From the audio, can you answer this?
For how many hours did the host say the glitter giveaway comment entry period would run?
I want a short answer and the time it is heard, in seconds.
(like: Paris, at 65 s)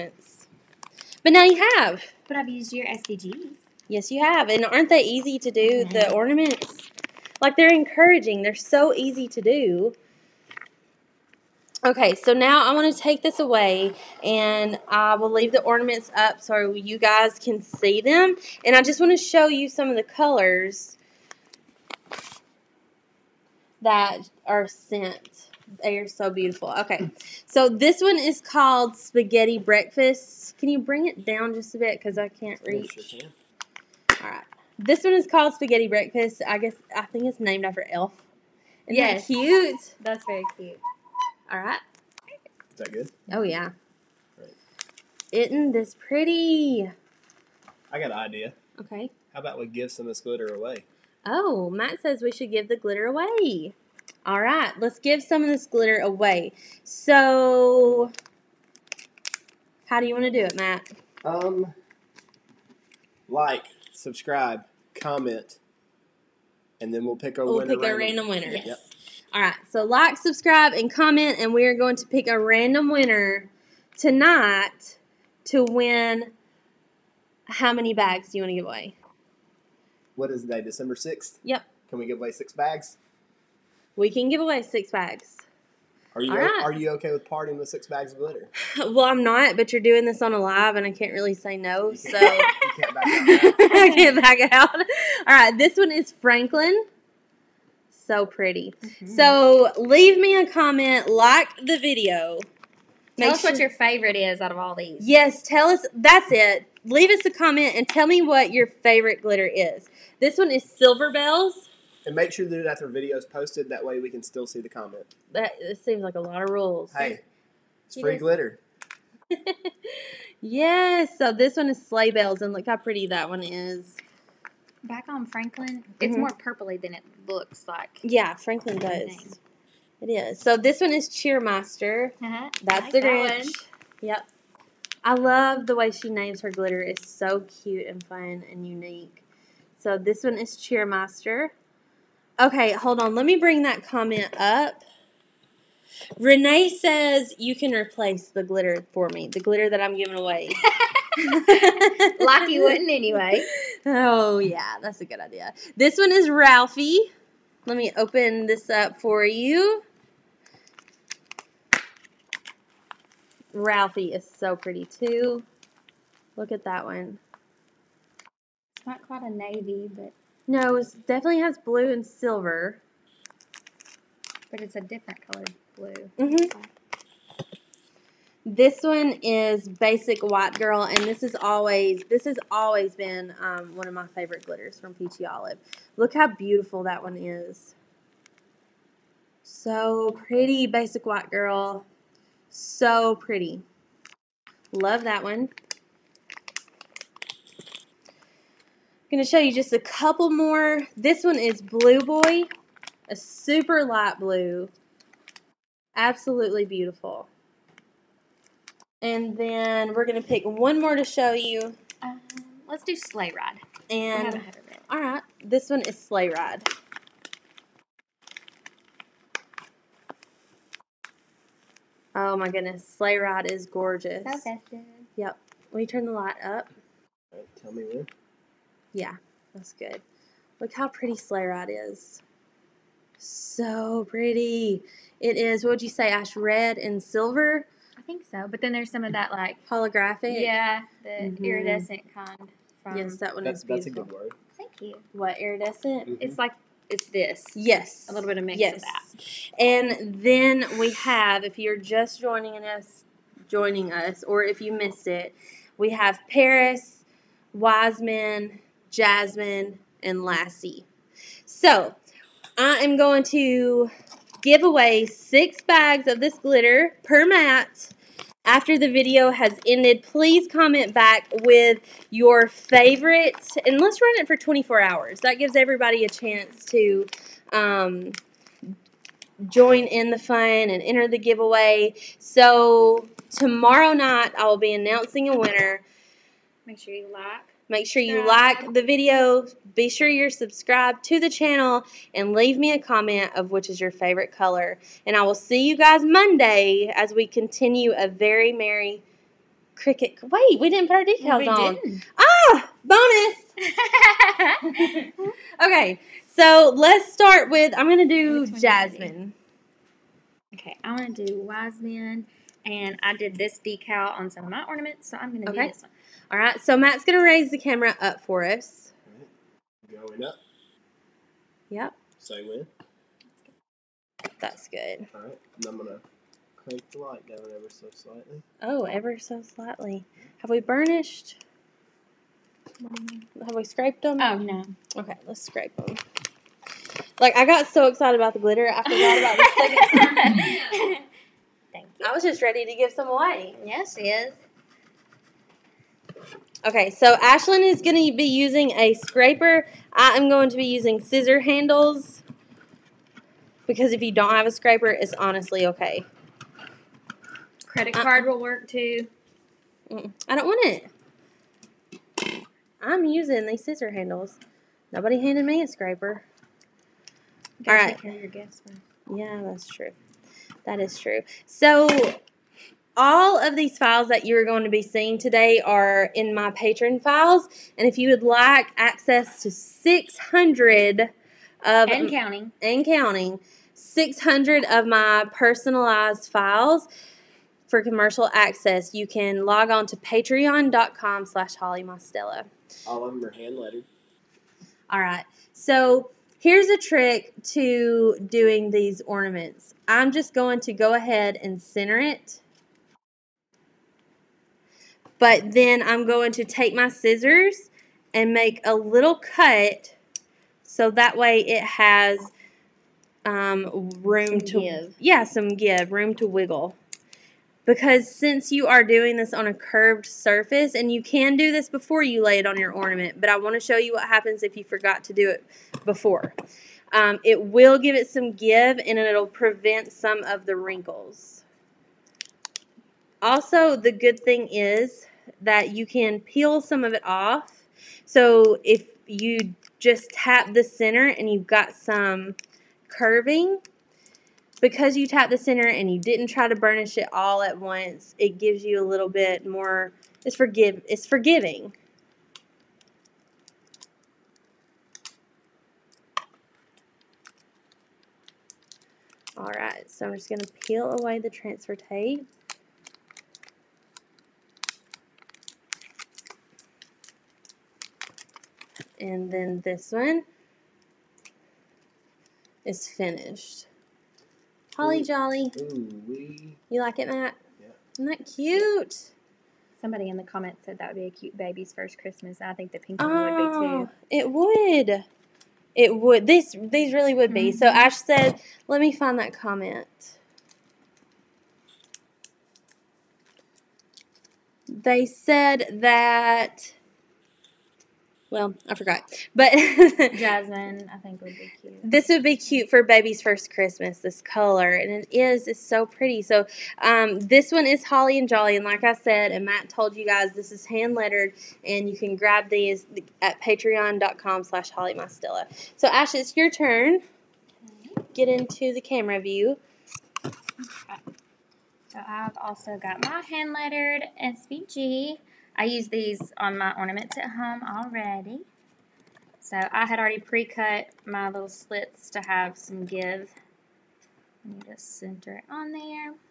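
24, at 274 s.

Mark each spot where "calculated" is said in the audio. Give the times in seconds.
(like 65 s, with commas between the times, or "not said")
not said.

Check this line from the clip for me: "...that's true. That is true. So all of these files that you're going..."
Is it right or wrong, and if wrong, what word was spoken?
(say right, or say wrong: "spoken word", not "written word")
right.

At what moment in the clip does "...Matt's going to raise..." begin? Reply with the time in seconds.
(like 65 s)
316 s.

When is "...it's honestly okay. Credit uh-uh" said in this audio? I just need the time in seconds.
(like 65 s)
354 s.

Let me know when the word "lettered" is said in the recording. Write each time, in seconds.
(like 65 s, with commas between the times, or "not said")
393 s, 510 s, 523 s.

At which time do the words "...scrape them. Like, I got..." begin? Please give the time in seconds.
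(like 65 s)
335 s.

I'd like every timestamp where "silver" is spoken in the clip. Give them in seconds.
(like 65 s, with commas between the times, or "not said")
110 s, 172 s, 237 s.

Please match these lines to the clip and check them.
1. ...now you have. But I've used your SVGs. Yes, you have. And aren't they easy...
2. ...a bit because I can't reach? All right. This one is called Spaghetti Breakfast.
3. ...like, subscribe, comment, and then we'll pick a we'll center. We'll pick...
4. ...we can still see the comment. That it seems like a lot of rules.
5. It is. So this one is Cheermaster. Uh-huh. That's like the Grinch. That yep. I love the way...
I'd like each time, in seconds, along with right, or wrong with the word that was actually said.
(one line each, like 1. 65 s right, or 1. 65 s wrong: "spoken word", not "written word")
1. 1 s right
2. 31 s right
3. 63 s wrong: "winner", not "center"
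4. 114 s right
5. 130 s right.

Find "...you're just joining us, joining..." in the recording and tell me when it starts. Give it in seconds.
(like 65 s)
251 s.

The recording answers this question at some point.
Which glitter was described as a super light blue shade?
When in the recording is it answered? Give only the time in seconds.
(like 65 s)
201 s.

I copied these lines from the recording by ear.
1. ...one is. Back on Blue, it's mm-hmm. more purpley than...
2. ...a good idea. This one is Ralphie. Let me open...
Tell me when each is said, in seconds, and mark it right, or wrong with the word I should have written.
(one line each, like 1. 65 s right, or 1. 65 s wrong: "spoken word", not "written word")
1. 123 s wrong: "Franklin", not "Blue"
2. 155 s right.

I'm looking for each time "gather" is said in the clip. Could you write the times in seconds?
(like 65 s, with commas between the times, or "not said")
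not said.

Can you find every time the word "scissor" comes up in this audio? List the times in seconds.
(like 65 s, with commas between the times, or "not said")
351 s, 363 s, 406 s.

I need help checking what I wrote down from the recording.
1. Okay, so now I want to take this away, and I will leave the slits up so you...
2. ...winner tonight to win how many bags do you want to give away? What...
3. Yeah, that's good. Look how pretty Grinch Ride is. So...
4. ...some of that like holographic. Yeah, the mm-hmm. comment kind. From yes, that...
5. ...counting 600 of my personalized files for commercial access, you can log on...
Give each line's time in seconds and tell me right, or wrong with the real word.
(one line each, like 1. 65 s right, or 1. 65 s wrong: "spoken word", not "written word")
1. 11 s wrong: "ornaments", not "slits"
2. 72 s right
3. 228 s wrong: "Sleigh", not "Grinch"
4. 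238 s wrong: "iridescent", not "comment"
5. 382 s right.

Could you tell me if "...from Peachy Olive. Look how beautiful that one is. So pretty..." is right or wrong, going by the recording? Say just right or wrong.
right.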